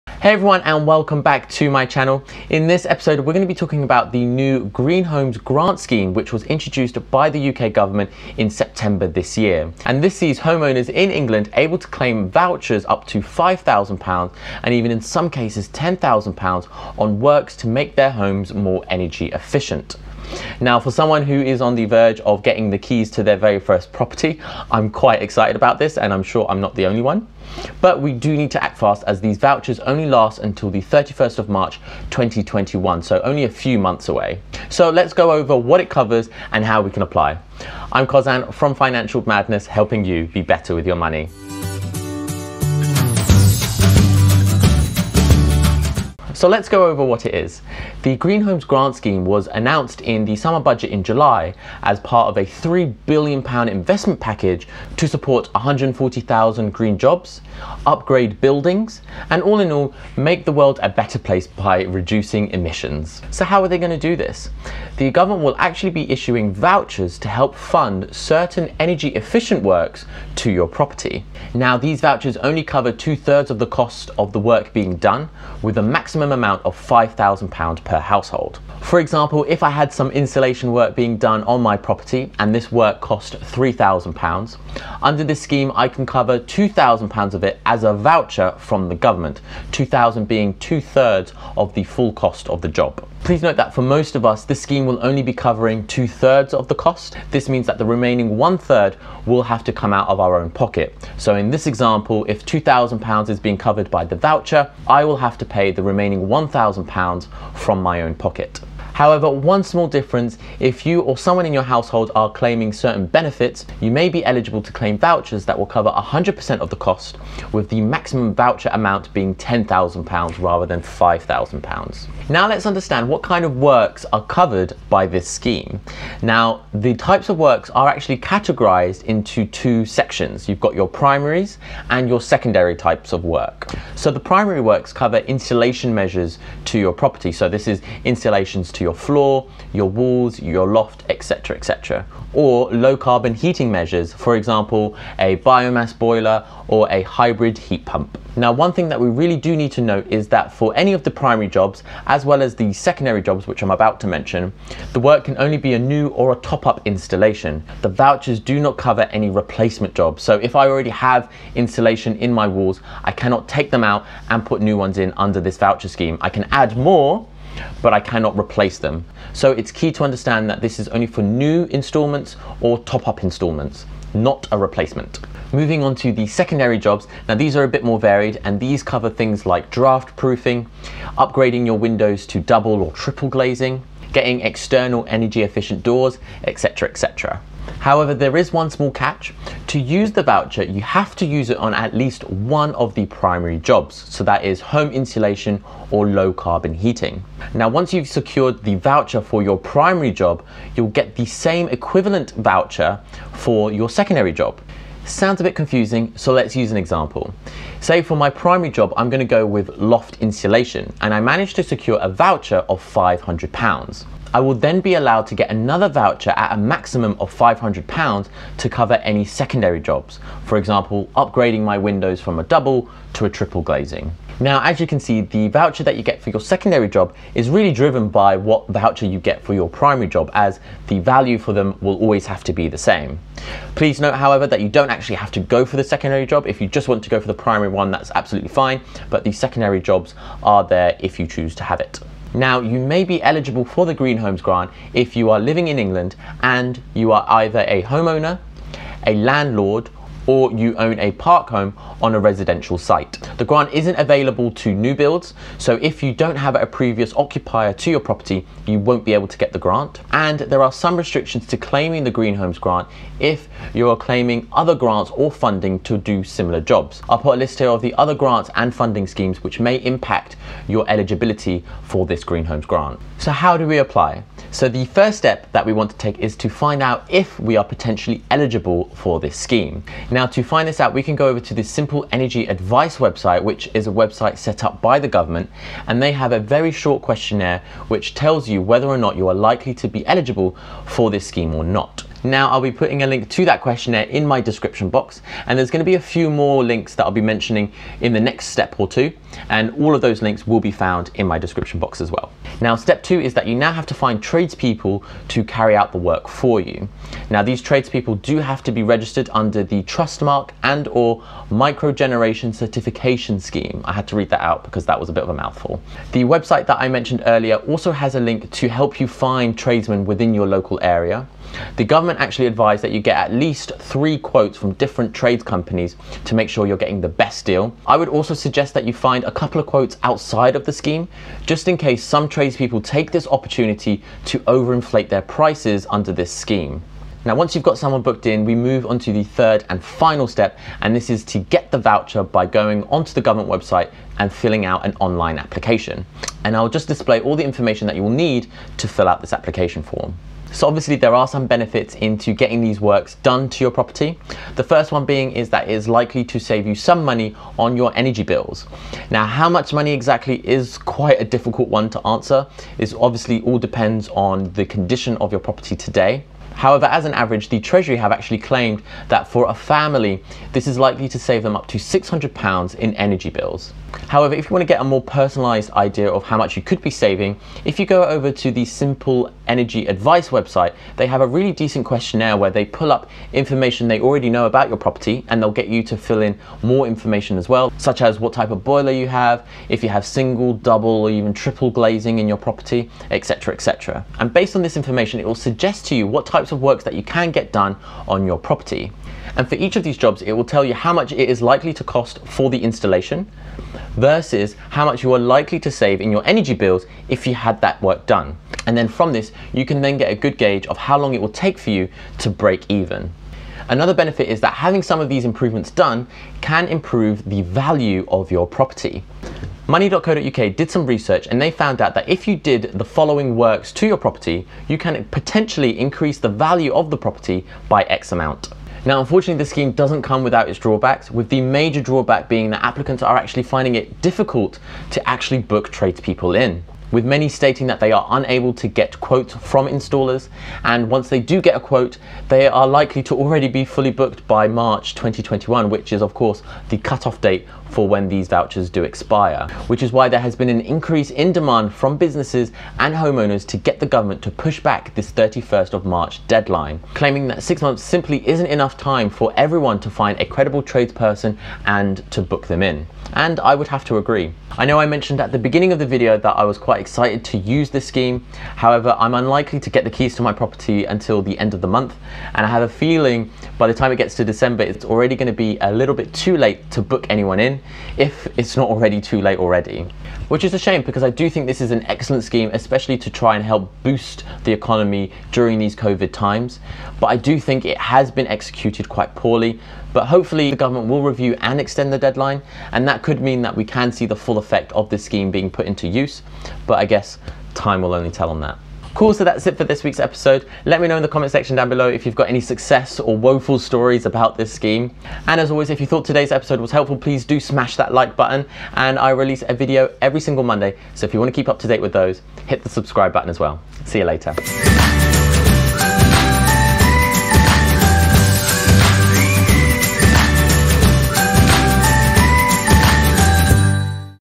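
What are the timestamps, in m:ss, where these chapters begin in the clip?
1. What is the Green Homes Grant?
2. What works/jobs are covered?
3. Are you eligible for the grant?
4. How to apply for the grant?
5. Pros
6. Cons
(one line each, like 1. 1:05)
1. 0:46
2. 2:02
3. 4:03
4. 4:35
5. 5:52
6. 7:09.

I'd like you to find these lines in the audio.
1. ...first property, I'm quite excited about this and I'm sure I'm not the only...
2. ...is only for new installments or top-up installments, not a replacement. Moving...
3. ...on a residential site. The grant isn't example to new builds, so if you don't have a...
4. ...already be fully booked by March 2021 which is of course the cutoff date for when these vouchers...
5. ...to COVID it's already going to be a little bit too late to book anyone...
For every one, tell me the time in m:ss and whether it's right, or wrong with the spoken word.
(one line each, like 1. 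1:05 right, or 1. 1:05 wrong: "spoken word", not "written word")
1. 0:23 right
2. 2:50 right
3. 4:12 wrong: "available", not "example"
4. 7:23 right
5. 7:54 wrong: "December", not "COVID".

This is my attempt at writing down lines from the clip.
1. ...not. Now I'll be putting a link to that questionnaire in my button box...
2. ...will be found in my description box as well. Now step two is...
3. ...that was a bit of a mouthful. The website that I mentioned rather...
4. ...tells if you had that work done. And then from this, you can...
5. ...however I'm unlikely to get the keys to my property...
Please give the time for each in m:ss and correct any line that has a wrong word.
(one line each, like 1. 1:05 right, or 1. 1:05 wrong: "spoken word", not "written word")
1. 4:51 wrong: "description", not "button"
2. 5:00 right
3. 5:14 wrong: "earlier", not "rather"
4. 6:46 wrong: "bills", not "tells"
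5. 7:48 right.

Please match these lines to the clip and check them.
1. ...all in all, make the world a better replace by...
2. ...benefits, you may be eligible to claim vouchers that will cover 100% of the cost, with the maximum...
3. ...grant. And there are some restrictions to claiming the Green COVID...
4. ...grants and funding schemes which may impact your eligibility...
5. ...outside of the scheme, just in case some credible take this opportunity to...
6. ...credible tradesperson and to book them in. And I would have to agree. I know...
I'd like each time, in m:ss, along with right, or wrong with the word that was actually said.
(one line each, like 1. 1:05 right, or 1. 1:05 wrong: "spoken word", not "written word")
1. 0:59 wrong: "place", not "replace"
2. 1:53 right
3. 4:19 wrong: "Homes", not "COVID"
4. 4:28 right
5. 5:30 wrong: "tradespeople", not "credible"
6. 7:40 right.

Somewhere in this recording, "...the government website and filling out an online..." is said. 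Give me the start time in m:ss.
5:43.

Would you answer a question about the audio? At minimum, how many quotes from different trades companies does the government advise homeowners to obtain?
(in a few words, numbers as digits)
3.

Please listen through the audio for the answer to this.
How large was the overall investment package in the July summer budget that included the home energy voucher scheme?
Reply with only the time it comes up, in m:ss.
0:52.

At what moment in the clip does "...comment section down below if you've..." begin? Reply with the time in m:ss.
8:21.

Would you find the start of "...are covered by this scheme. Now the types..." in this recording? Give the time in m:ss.
2:04.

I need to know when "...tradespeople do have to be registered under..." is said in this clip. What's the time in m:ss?
5:07.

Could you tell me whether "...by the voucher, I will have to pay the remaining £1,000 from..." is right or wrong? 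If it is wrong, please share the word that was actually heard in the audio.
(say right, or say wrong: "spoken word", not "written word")
right.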